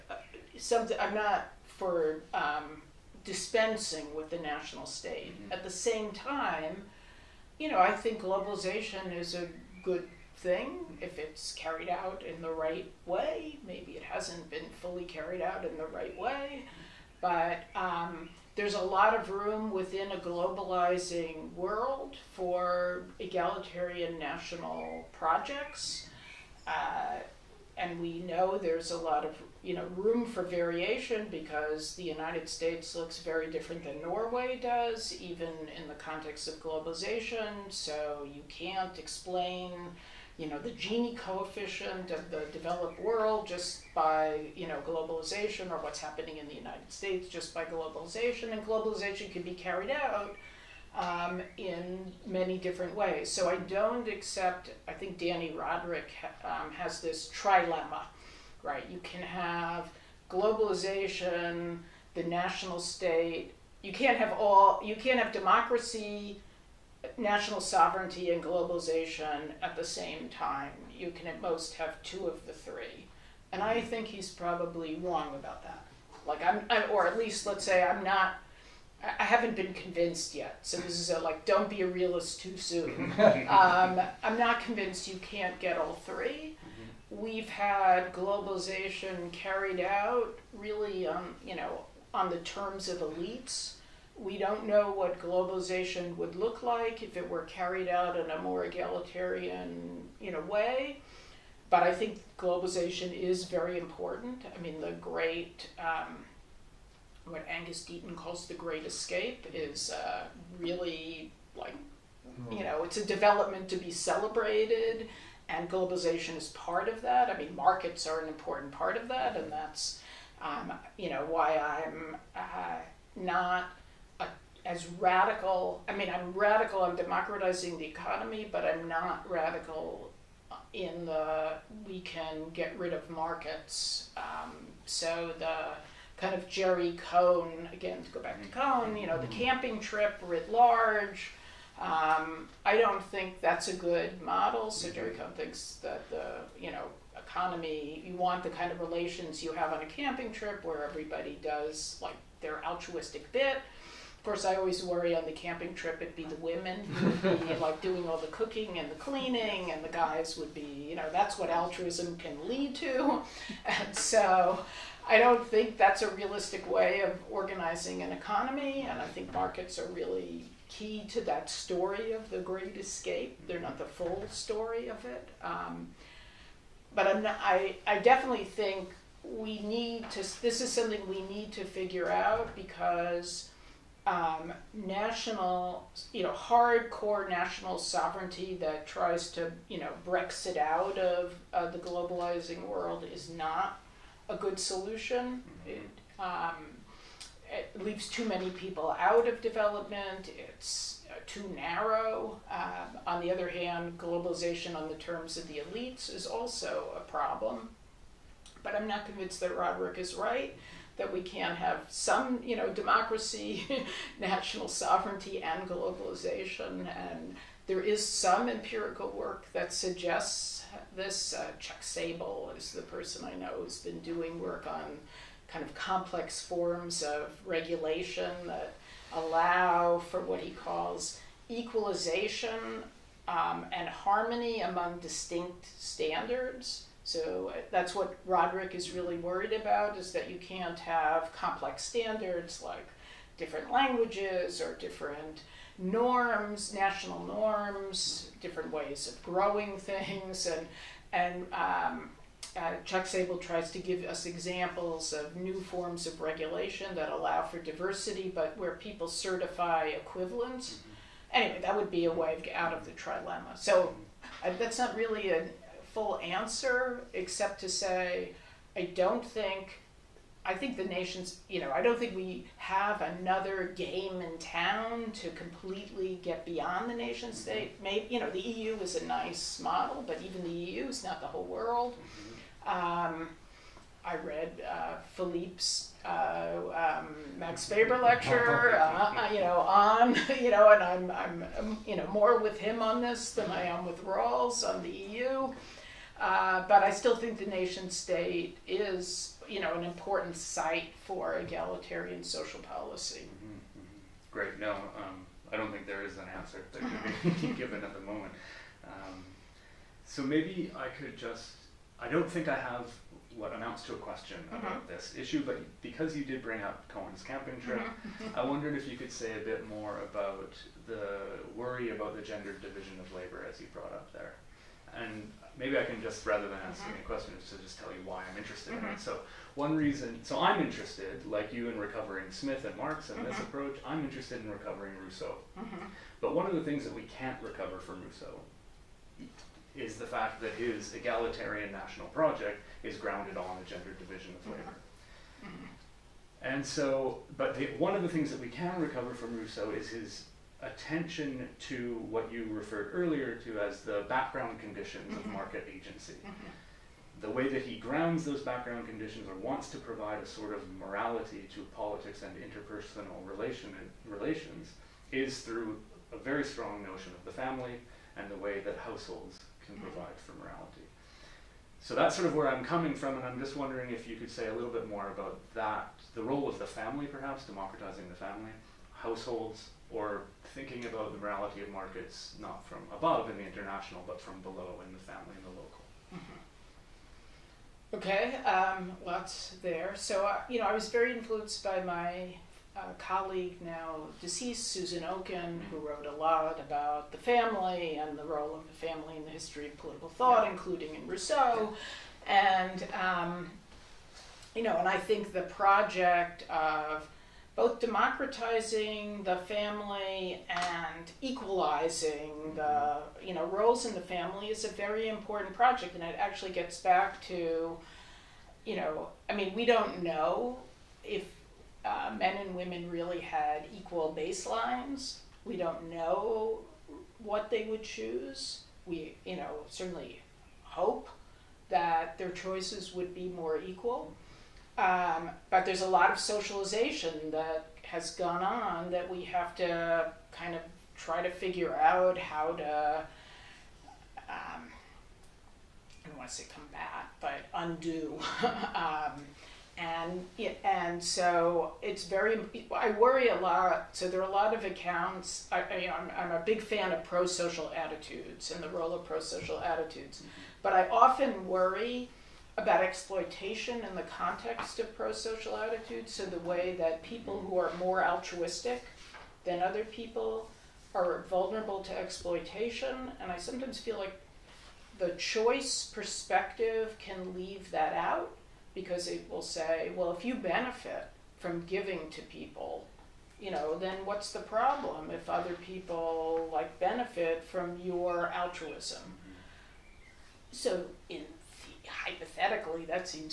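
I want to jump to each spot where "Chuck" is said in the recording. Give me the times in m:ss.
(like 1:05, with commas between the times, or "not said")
3:41, 4:12.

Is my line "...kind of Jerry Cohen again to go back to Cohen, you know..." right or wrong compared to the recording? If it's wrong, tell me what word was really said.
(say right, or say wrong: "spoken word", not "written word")
right.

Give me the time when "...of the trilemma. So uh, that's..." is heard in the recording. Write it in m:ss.
4:22.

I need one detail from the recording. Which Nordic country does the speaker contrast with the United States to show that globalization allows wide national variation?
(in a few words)
Norway.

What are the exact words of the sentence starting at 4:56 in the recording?
Uh, but I still think the nation state is, you know, an important site for egalitarian social policy.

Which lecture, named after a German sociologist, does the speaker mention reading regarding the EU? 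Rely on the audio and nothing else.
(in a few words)
Max Weber lecture.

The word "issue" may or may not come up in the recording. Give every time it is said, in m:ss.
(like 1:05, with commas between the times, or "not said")
5:15.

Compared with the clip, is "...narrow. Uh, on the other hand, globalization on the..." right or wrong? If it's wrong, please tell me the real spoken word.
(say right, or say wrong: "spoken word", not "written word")
right.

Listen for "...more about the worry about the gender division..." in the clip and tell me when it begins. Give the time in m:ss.
5:19.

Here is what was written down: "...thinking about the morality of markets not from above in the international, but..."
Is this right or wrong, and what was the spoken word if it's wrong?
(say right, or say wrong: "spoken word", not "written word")
right.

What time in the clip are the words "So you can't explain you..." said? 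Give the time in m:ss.
0:37.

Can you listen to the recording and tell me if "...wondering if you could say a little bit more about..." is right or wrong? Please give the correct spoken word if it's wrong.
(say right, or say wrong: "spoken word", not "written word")
right.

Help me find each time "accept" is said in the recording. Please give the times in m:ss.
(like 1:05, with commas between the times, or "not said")
0:54.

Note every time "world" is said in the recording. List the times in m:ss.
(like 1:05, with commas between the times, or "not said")
0:21, 0:42, 3:12, 4:41.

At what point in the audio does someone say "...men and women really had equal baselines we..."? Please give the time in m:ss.
7:02.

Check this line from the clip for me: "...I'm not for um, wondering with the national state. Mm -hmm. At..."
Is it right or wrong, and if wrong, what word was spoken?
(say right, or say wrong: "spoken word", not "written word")
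wrong: "dispensing", not "wondering".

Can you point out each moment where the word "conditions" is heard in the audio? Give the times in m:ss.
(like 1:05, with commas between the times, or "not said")
5:54, 5:58.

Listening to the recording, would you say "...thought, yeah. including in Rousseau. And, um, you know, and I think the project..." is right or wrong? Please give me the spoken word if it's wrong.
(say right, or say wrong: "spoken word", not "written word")
right.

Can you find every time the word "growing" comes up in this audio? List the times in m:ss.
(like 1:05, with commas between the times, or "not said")
4:09.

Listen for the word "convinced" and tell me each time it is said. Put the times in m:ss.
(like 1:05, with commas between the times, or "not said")
1:19, 1:24, 3:29.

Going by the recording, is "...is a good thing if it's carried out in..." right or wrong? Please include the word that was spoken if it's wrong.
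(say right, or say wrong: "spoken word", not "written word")
right.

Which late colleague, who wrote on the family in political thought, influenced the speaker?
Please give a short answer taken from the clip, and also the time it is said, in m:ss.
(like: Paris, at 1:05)
Susan Okin, at 6:34.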